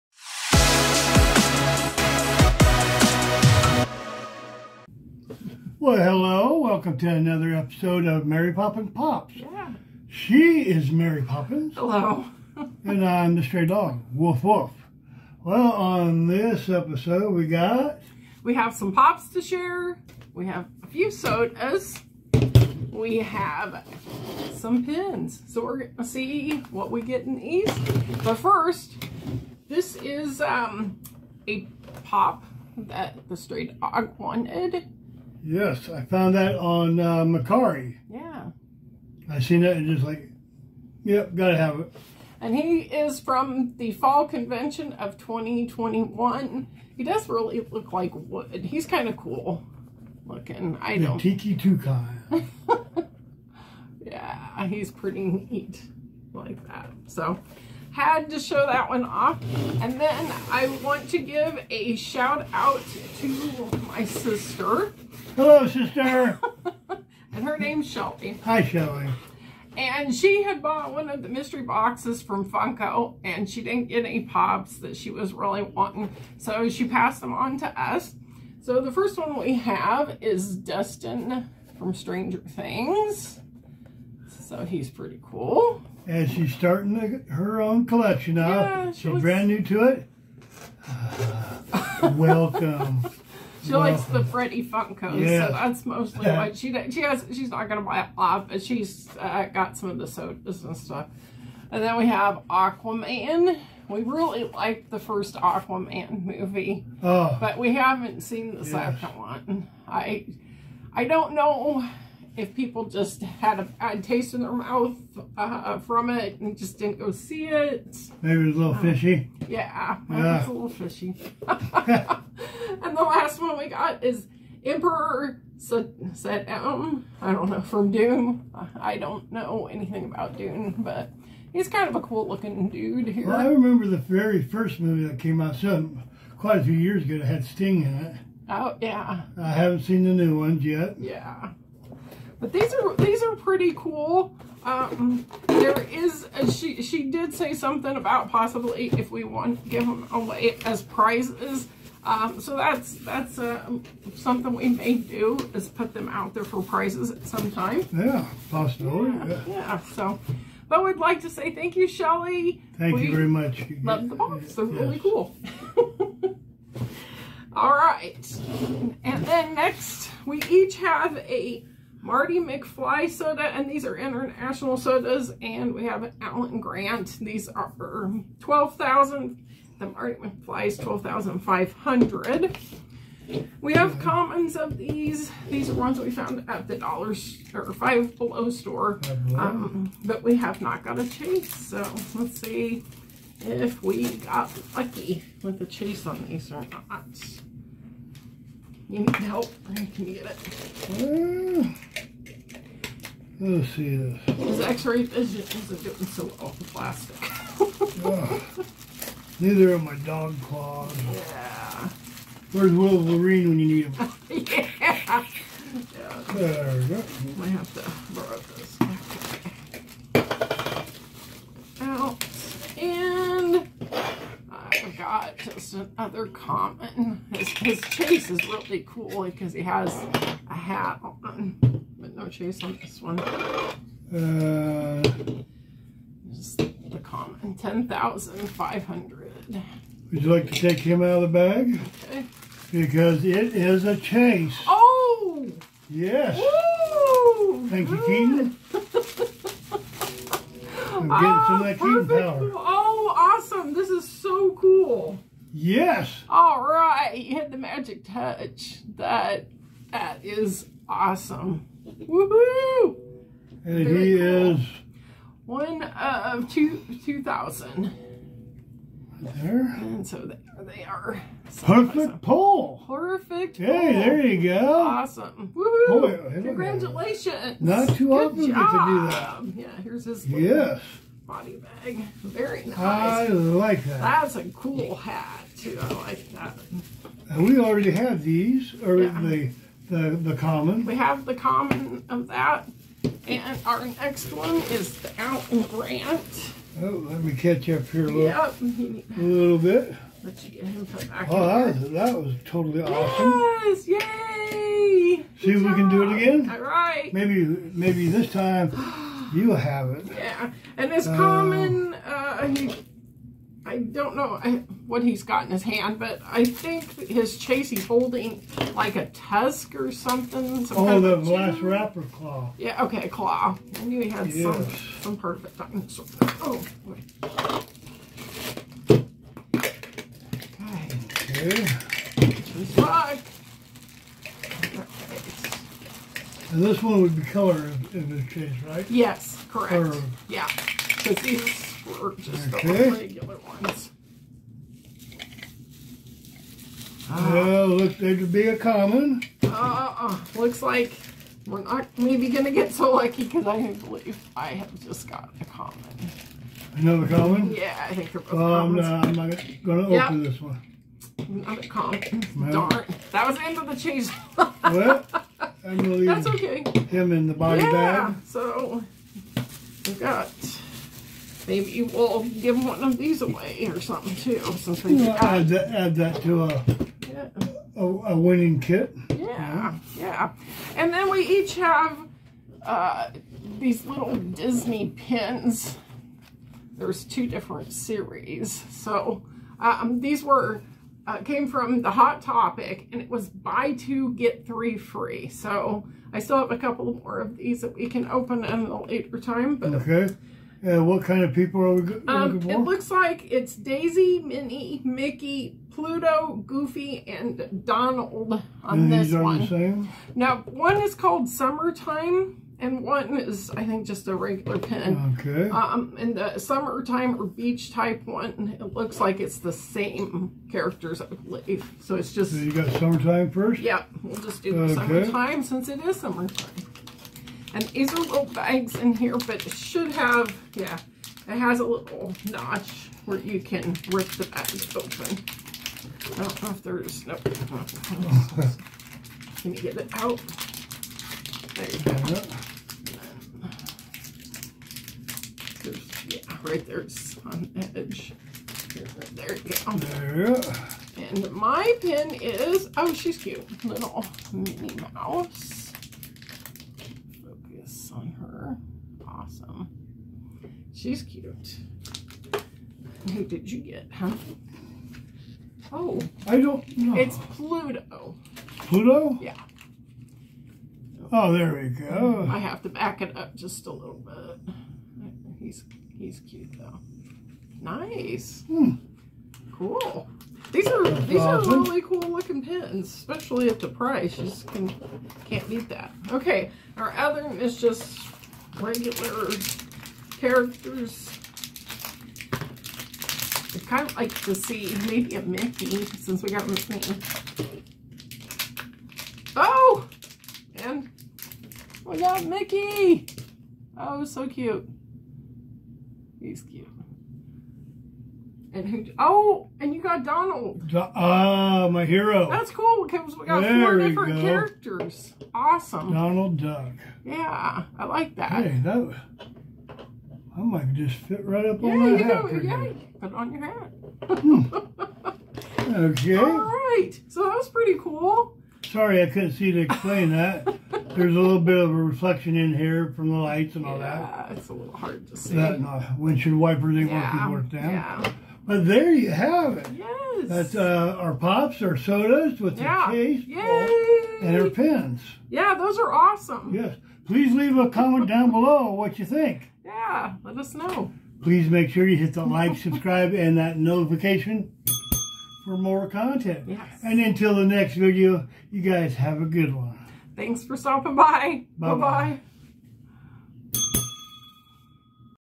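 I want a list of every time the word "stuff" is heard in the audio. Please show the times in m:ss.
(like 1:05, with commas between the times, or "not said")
1:40.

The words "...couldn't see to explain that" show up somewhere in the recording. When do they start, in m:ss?
8:49.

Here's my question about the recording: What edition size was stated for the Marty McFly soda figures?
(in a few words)
12,500.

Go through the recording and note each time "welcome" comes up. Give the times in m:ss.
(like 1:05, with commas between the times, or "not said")
0:06, 1:32.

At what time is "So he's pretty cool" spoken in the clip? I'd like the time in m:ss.
1:24.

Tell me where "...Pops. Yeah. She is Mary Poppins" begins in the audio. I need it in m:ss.
0:08.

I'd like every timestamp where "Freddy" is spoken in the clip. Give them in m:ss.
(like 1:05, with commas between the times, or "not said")
1:34.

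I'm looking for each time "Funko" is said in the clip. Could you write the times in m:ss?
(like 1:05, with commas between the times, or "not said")
1:12, 1:34.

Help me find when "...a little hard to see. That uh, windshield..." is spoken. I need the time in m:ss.
8:54.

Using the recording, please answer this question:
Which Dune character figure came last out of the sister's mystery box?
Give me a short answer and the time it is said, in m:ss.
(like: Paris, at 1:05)
Emperor Shaddam, at 2:04.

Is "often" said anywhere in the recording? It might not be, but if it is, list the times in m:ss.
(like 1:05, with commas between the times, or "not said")
4:38.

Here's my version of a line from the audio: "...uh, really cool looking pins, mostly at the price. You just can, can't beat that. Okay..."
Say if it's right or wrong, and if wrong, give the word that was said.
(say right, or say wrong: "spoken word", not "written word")
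wrong: "especially", not "mostly".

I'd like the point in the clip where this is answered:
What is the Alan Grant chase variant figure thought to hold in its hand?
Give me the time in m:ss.
5:20.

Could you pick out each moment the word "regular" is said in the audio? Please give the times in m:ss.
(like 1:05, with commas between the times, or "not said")
5:42, 6:54, 8:08.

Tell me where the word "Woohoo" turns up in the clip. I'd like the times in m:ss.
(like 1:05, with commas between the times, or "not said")
4:21, 4:35.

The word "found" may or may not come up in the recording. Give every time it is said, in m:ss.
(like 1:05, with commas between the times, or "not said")
0:36, 3:06.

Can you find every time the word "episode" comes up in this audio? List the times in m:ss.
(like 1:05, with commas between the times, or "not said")
0:07, 0:16.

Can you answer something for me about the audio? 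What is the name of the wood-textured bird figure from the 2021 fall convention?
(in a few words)
Tiki Toucan.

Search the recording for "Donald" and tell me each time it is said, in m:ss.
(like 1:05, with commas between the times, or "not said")
6:47, 8:30, 8:35.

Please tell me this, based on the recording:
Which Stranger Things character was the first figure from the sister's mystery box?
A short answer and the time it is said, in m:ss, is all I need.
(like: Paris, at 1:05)
Dustin, at 1:20.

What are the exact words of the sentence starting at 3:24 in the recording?
His x-ray vision isn't doing so well with plastic.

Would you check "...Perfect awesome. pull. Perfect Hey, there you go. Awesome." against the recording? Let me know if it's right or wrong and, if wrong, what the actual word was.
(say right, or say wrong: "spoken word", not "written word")
right.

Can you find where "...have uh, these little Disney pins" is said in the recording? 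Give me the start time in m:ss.
6:21.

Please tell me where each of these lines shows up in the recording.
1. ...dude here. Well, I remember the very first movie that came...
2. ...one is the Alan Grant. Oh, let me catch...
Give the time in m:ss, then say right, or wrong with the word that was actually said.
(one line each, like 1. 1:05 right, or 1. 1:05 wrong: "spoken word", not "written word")
1. 2:12 right
2. 4:54 right.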